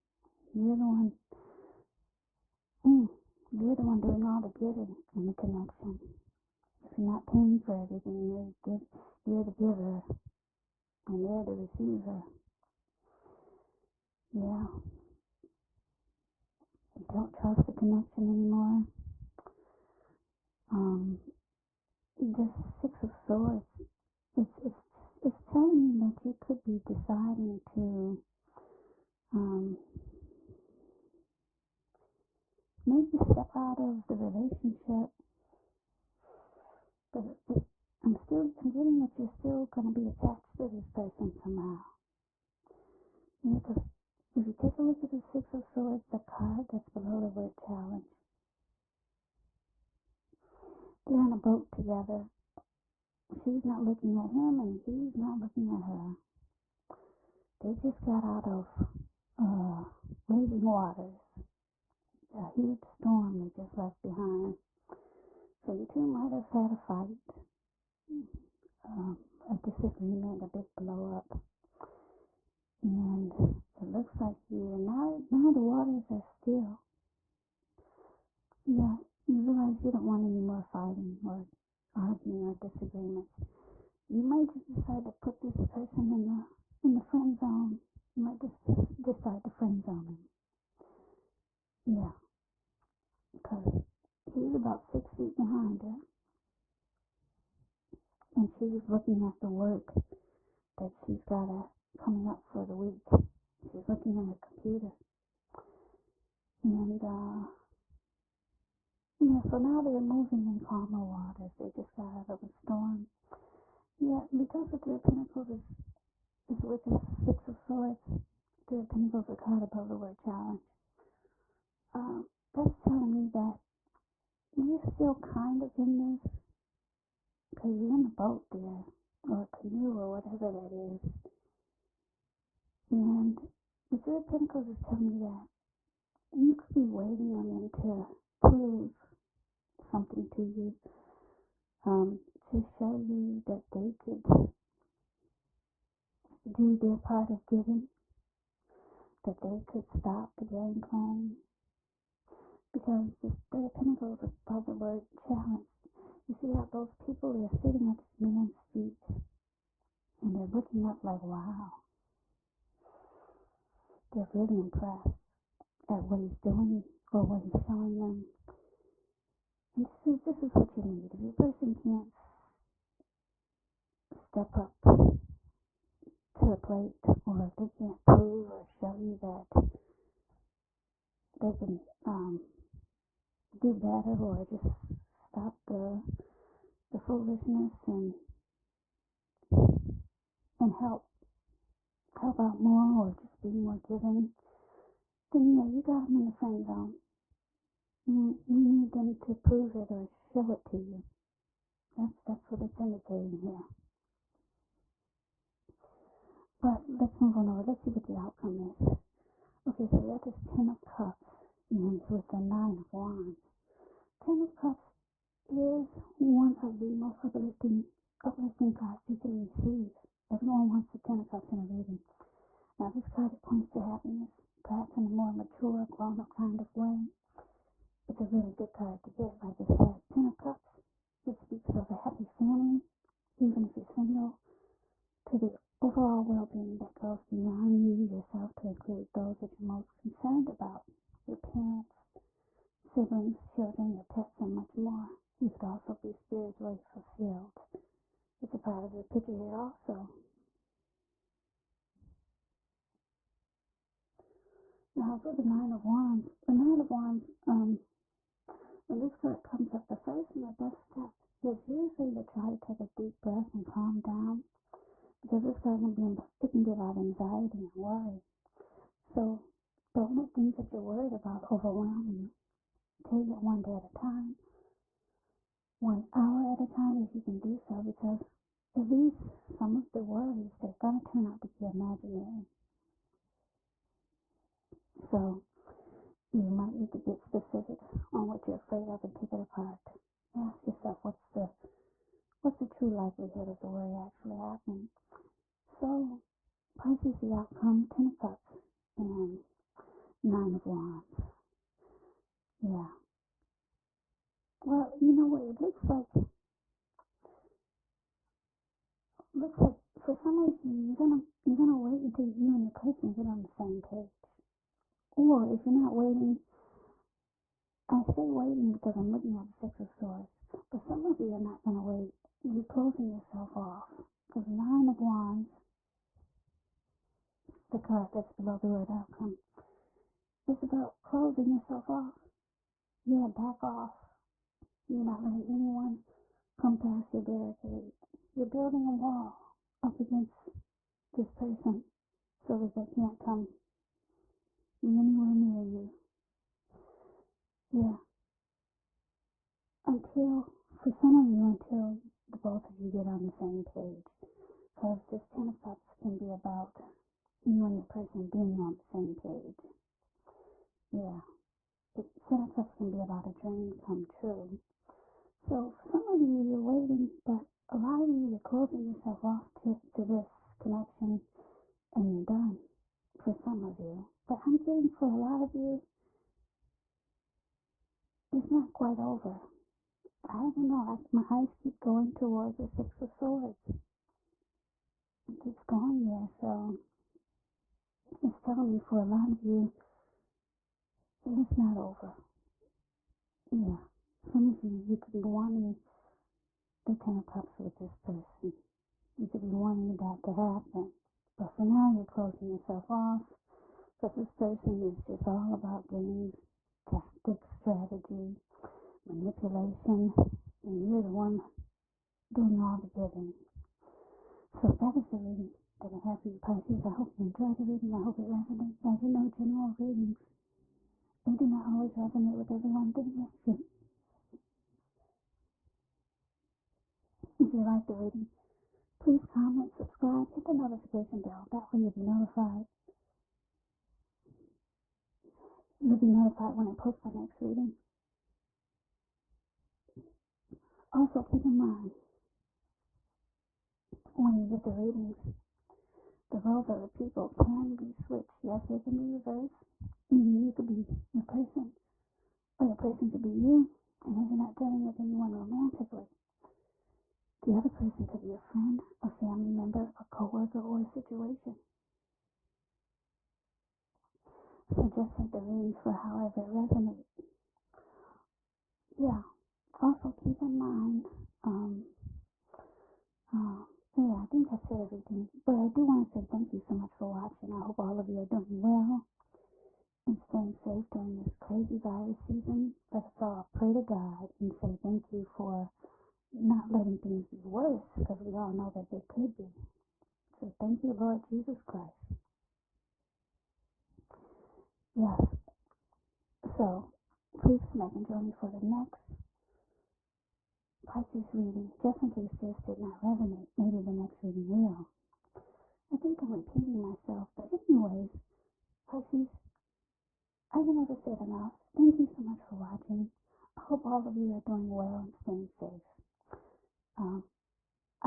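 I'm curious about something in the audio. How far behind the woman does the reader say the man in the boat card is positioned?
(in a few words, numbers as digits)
six feet.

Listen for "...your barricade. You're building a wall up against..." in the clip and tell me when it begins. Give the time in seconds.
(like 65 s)
337 s.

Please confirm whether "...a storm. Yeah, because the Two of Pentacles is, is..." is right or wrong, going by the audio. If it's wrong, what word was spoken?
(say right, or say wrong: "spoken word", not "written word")
wrong: "Three", not "Two".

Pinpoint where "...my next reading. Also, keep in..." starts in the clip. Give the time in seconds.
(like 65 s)
437 s.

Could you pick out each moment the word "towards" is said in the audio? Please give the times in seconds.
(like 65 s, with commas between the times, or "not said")
382 s.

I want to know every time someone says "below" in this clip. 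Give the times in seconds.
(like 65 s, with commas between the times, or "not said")
46 s, 328 s.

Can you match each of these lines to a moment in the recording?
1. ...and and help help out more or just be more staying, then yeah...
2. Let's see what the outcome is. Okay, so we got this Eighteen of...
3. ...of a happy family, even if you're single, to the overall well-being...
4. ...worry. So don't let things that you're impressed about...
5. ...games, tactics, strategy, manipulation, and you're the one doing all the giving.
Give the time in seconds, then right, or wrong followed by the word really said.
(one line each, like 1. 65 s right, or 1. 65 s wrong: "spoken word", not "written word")
1. 187 s wrong: "giving", not "staying"
2. 207 s wrong: "Ten", not "Eighteen"
3. 231 s right
4. 267 s wrong: "worried", not "impressed"
5. 405 s right.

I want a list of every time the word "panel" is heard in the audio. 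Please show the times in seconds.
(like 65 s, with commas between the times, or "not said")
not said.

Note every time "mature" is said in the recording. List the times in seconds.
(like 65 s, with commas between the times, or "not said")
225 s.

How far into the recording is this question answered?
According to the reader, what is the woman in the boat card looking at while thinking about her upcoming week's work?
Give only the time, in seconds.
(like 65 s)
104 s.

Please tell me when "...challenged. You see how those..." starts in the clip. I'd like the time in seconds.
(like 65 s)
155 s.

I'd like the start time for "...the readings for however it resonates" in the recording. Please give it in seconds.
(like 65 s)
465 s.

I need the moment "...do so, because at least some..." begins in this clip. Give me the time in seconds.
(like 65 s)
277 s.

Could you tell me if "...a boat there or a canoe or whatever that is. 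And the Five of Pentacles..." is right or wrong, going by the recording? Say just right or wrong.
wrong.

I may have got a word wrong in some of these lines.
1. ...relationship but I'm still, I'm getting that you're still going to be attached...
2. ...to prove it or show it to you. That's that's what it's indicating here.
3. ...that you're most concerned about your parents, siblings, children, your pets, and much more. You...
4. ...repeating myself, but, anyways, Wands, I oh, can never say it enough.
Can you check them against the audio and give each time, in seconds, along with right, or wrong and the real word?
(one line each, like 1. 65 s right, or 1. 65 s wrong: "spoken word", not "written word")
1. 34 s right
2. 199 s right
3. 239 s right
4. 506 s wrong: "Pisces", not "Wands".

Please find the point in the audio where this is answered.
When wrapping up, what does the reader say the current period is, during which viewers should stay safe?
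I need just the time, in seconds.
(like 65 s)
481 s.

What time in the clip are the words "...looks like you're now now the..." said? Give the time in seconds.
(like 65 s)
73 s.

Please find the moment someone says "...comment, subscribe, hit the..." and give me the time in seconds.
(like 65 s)
429 s.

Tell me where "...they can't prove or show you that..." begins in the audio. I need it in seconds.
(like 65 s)
177 s.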